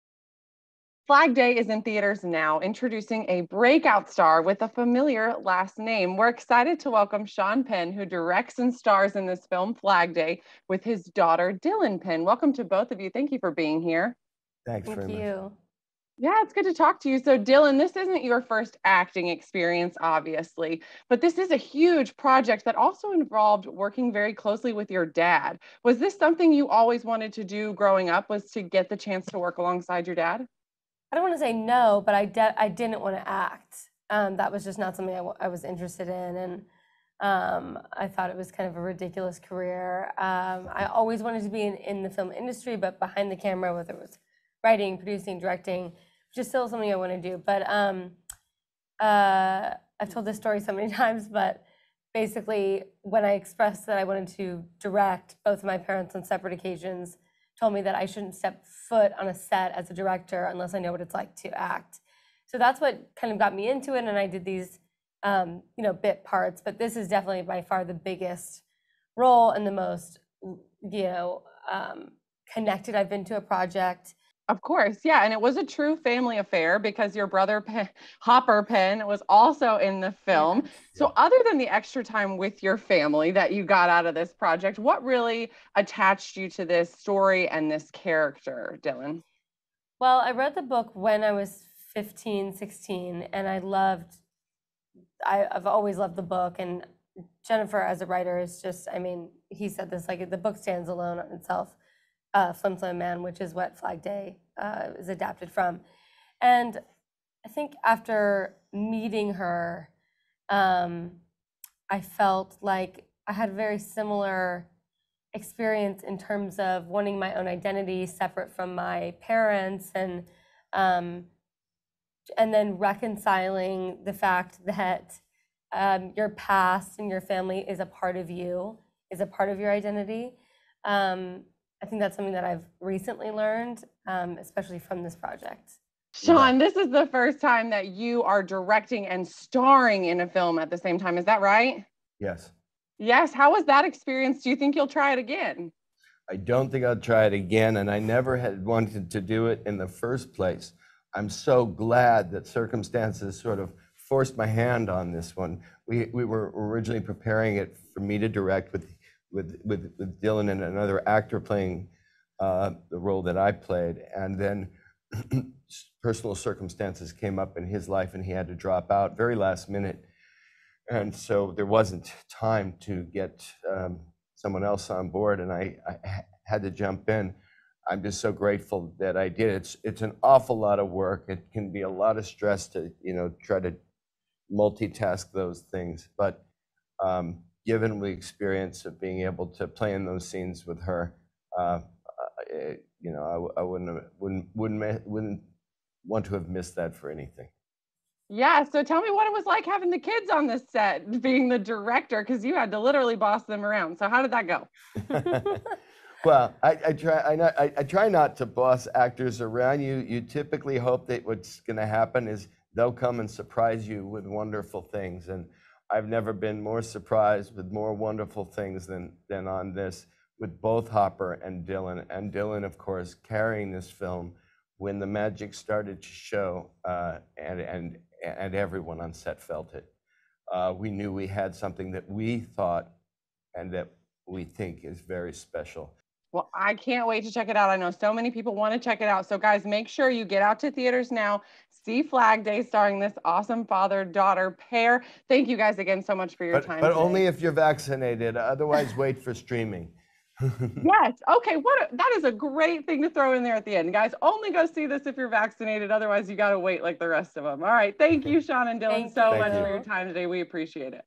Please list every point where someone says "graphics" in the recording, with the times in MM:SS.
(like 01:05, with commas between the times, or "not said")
not said.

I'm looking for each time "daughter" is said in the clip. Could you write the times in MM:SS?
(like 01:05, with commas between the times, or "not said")
00:11, 04:04.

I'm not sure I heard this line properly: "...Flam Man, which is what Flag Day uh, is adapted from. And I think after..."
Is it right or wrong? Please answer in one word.
right.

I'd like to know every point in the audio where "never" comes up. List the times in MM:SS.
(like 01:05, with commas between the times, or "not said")
02:27, 03:36.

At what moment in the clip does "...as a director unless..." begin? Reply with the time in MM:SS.
00:59.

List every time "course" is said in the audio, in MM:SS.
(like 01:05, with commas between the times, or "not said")
01:14, 03:42.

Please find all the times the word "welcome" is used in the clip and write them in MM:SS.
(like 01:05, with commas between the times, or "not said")
00:06, 00:12.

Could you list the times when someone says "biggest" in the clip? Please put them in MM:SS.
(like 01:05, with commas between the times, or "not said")
01:07.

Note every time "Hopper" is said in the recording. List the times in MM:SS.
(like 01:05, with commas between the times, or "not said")
01:18, 03:40.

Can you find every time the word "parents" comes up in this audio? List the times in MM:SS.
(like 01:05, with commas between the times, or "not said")
00:55, 01:59.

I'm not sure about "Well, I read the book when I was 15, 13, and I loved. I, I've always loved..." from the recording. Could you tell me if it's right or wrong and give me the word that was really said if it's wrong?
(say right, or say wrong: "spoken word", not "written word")
wrong: "16", not "13".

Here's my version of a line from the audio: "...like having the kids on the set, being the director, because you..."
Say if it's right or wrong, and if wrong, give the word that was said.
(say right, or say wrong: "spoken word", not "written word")
right.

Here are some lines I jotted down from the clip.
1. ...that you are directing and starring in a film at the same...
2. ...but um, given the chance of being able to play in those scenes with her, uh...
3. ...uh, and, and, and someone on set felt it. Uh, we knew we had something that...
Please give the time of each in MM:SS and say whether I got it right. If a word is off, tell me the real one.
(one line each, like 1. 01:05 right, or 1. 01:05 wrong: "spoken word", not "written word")
1. 02:17 right
2. 03:06 wrong: "experience", not "chance"
3. 03:46 wrong: "everyone", not "someone".